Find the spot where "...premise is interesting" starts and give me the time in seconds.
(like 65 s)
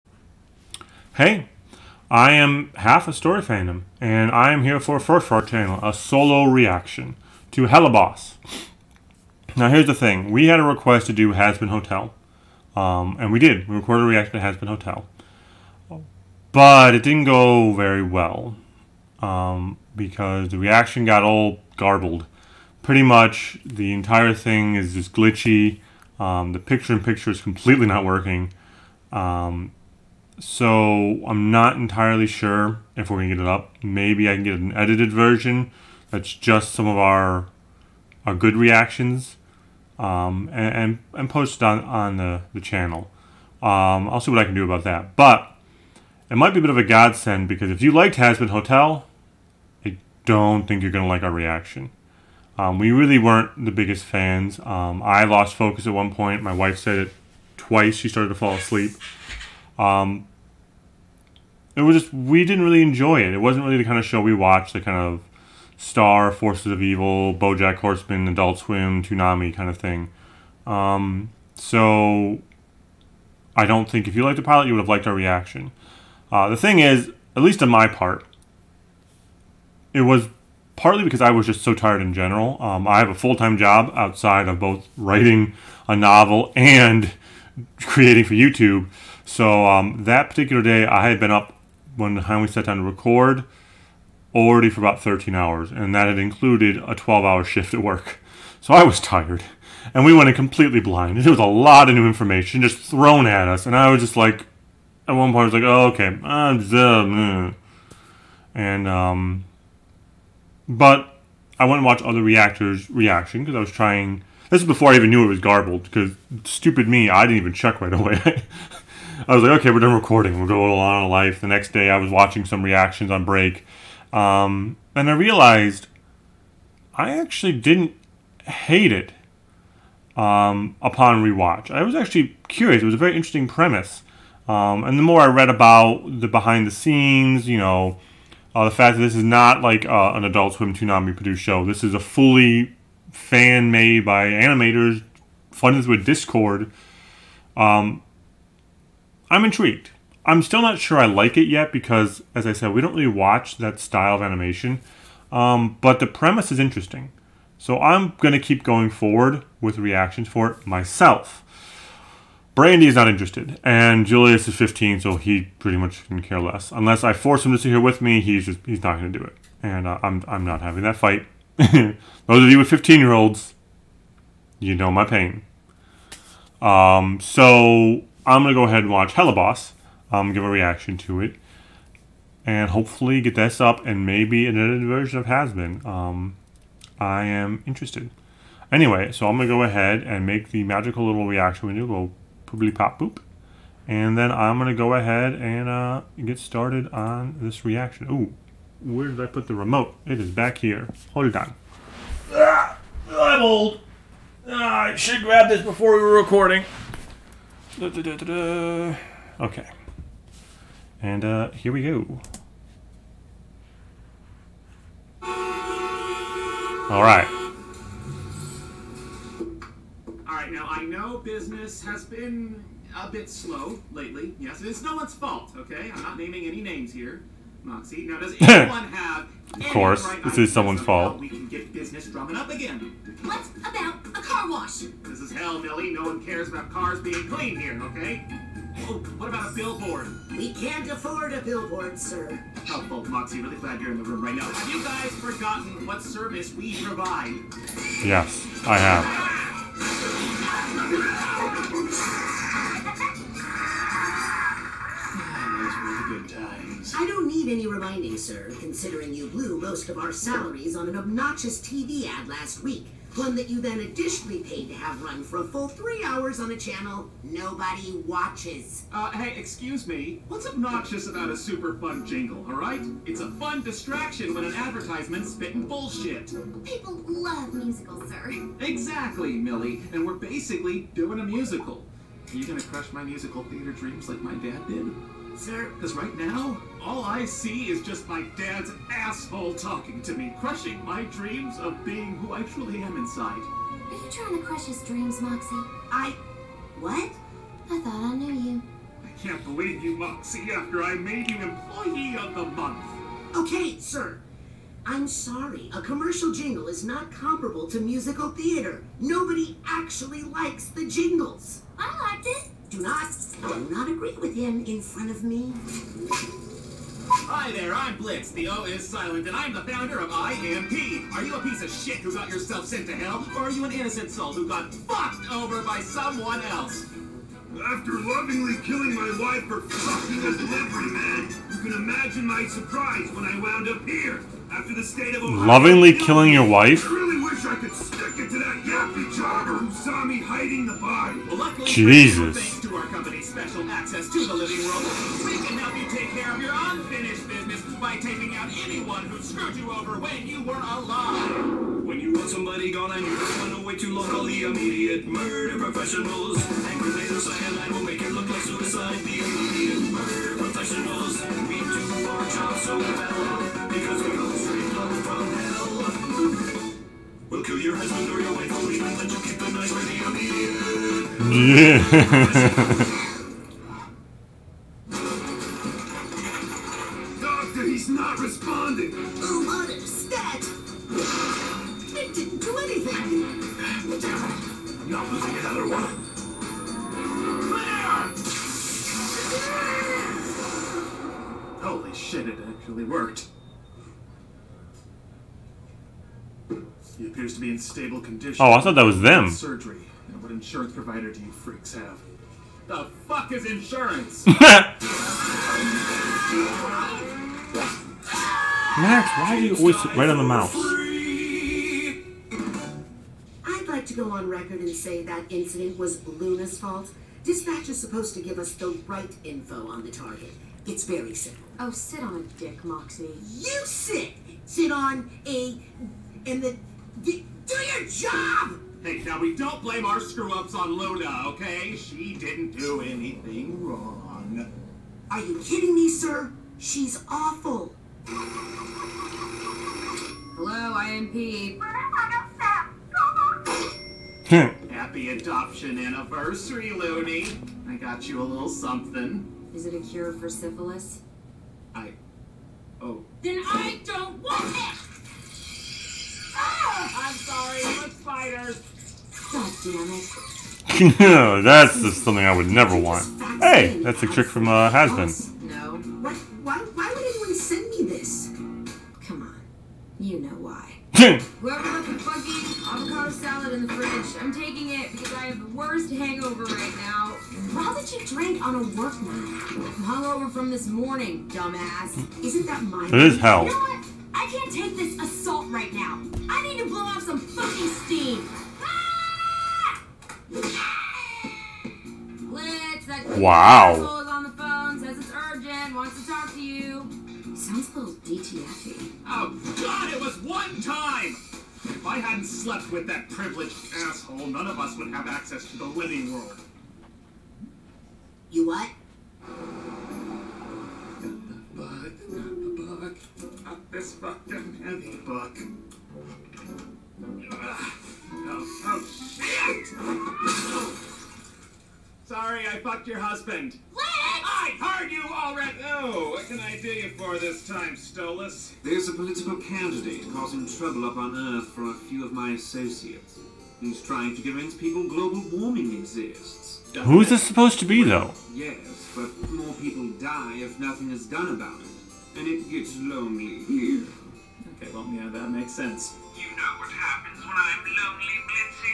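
156 s.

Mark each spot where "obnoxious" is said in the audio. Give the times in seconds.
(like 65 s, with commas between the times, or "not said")
260 s, 270 s.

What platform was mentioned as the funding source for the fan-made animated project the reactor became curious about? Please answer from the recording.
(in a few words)
Discord.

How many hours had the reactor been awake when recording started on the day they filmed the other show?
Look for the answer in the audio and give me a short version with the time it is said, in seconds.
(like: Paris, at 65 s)
13, at 95 s.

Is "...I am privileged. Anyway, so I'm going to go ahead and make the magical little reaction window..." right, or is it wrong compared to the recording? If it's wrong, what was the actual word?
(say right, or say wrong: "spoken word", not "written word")
wrong: "interested", not "privileged".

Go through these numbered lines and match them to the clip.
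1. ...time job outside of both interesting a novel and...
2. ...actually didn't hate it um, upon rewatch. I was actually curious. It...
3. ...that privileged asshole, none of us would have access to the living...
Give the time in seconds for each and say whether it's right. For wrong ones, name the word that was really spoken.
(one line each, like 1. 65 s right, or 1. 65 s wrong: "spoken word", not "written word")
1. 83 s wrong: "writing", not "interesting"
2. 127 s right
3. 502 s right.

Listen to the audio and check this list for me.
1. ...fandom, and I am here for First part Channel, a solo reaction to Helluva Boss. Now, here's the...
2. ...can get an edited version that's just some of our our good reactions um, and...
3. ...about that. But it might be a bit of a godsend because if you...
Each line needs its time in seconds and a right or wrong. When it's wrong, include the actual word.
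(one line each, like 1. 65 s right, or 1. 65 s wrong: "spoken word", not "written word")
1. 3 s right
2. 34 s right
3. 44 s right.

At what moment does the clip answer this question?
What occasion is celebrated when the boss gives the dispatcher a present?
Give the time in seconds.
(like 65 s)
445 s.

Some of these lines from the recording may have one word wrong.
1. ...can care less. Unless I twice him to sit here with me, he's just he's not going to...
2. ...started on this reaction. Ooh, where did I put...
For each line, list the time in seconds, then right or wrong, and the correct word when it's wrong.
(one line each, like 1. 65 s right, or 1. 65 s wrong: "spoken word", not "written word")
1. 166 s wrong: "force", not "twice"
2. 196 s right.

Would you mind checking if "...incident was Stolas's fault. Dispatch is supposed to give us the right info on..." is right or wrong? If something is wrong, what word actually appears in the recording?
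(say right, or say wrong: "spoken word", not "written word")
wrong: "Loona", not "Stolas".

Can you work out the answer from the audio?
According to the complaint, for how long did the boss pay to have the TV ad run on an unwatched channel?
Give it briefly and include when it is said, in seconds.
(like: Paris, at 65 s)
Three hours, at 265 s.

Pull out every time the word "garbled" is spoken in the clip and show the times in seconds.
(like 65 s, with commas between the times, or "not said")
21 s, 115 s.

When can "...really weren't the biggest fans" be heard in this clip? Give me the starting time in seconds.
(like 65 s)
52 s.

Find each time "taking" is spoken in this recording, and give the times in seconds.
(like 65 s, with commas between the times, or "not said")
347 s, 474 s.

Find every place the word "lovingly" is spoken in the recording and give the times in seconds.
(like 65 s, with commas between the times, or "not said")
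327 s, 335 s.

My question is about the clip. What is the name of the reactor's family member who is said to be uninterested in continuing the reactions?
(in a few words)
Brandy.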